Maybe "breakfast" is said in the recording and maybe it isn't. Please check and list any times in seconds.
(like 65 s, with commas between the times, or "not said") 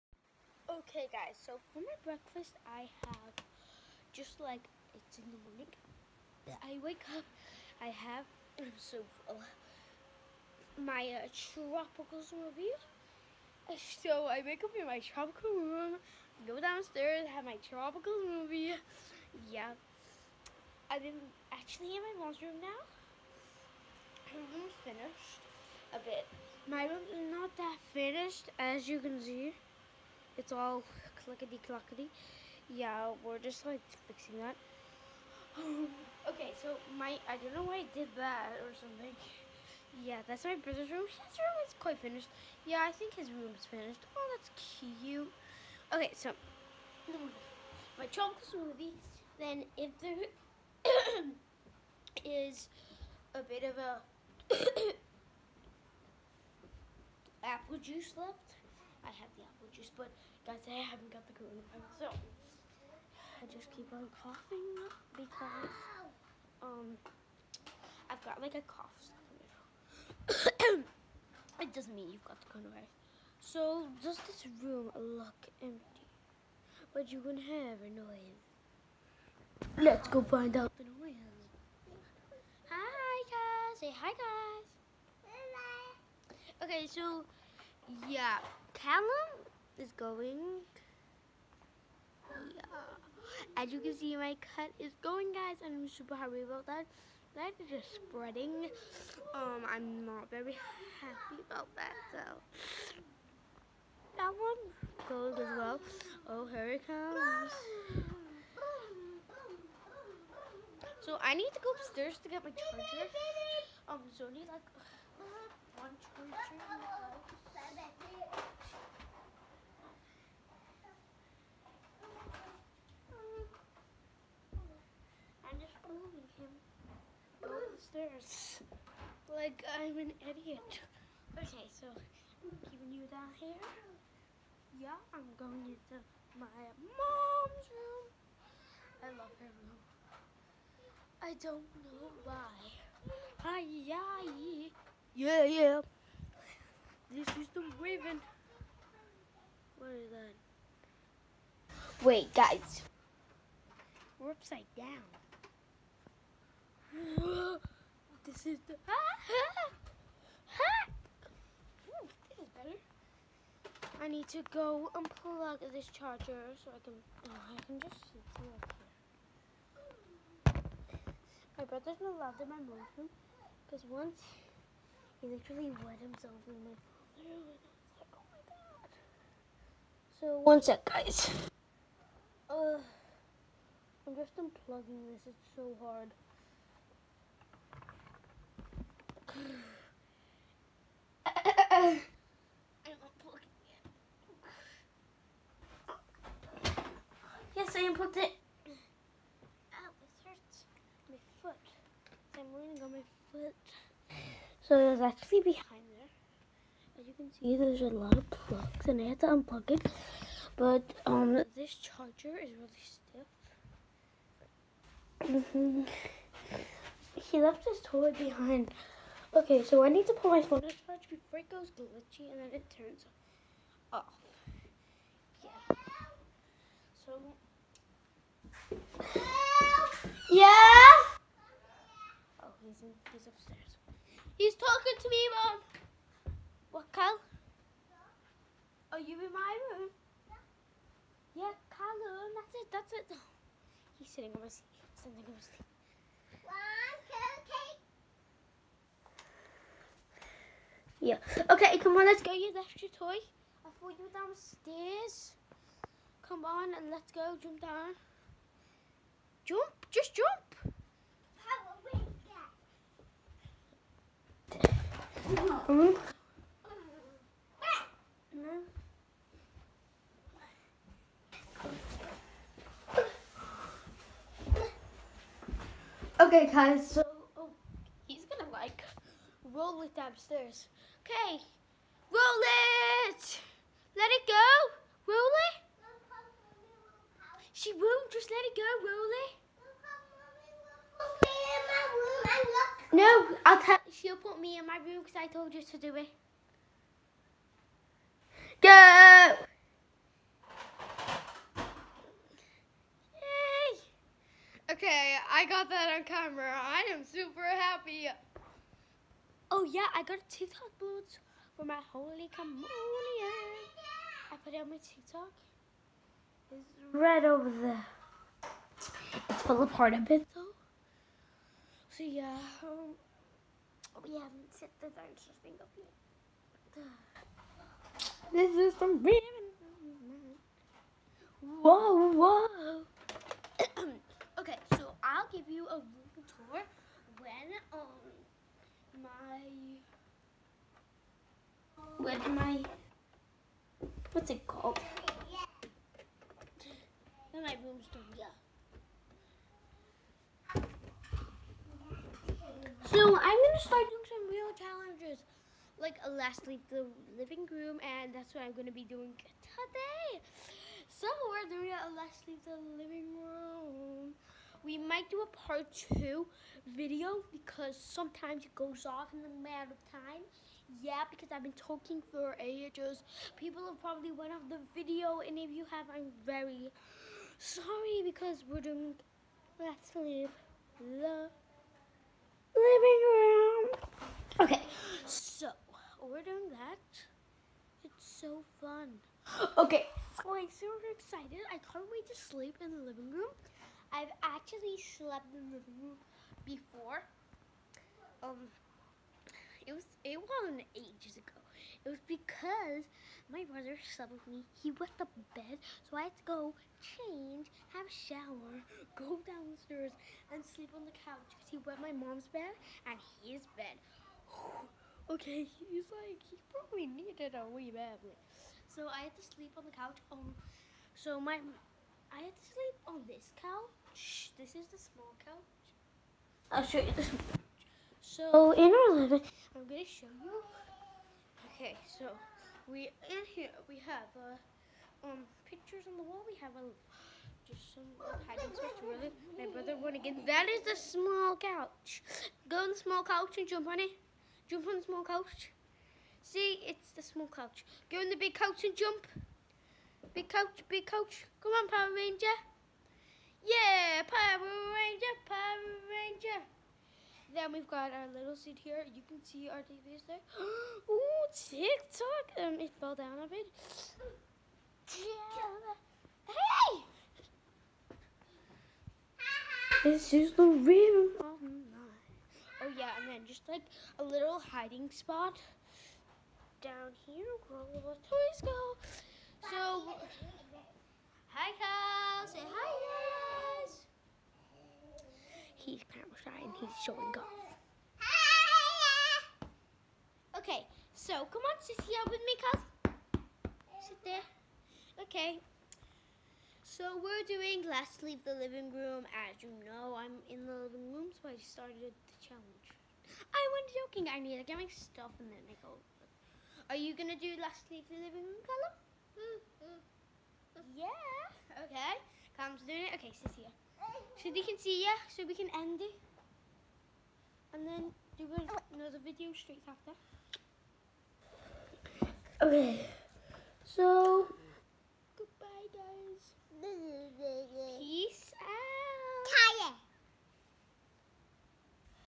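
2 s.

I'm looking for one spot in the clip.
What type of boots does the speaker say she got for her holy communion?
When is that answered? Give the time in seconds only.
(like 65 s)
310 s.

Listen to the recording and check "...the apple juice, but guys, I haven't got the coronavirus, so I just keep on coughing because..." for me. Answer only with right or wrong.
right.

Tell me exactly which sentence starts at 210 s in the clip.
But um, this charger is really stiff.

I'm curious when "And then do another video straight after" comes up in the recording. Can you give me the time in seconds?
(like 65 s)
517 s.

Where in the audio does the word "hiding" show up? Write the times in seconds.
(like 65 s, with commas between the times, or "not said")
438 s, 474 s.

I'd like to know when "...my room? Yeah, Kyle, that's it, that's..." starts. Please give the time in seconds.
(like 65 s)
239 s.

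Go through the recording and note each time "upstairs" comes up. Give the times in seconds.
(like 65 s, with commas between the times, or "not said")
111 s, 233 s.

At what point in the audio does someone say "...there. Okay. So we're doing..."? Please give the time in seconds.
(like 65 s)
494 s.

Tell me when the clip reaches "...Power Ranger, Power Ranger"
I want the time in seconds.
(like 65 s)
454 s.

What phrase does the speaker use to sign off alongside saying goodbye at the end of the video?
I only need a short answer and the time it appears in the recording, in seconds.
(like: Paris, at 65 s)
Peace out, at 527 s.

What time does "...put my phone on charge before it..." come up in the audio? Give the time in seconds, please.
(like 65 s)
220 s.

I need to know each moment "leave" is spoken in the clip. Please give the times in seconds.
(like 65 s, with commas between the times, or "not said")
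356 s, 362 s, 379 s, 498 s, 507 s.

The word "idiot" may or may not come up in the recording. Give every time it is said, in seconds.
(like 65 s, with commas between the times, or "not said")
130 s.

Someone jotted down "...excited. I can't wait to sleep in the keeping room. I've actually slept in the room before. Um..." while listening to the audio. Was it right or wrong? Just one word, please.
wrong.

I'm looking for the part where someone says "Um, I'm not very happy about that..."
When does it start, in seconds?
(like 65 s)
99 s.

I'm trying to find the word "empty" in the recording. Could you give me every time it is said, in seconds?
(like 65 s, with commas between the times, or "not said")
75 s.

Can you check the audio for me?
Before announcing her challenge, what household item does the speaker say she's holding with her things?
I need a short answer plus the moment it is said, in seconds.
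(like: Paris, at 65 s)
Broomstick, at 347 s.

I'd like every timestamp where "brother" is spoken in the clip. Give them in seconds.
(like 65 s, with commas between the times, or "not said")
40 s, 171 s, 403 s, 439 s.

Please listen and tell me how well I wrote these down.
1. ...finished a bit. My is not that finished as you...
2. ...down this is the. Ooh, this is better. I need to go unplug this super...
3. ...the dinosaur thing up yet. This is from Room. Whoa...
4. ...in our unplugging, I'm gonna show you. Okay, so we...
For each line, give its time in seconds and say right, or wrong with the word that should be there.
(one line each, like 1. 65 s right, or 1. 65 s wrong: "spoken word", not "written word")
1. 24 s right
2. 154 s wrong: "charger", not "super"
3. 324 s wrong: "Raven", not "Room"
4. 428 s wrong: "living", not "unplugging".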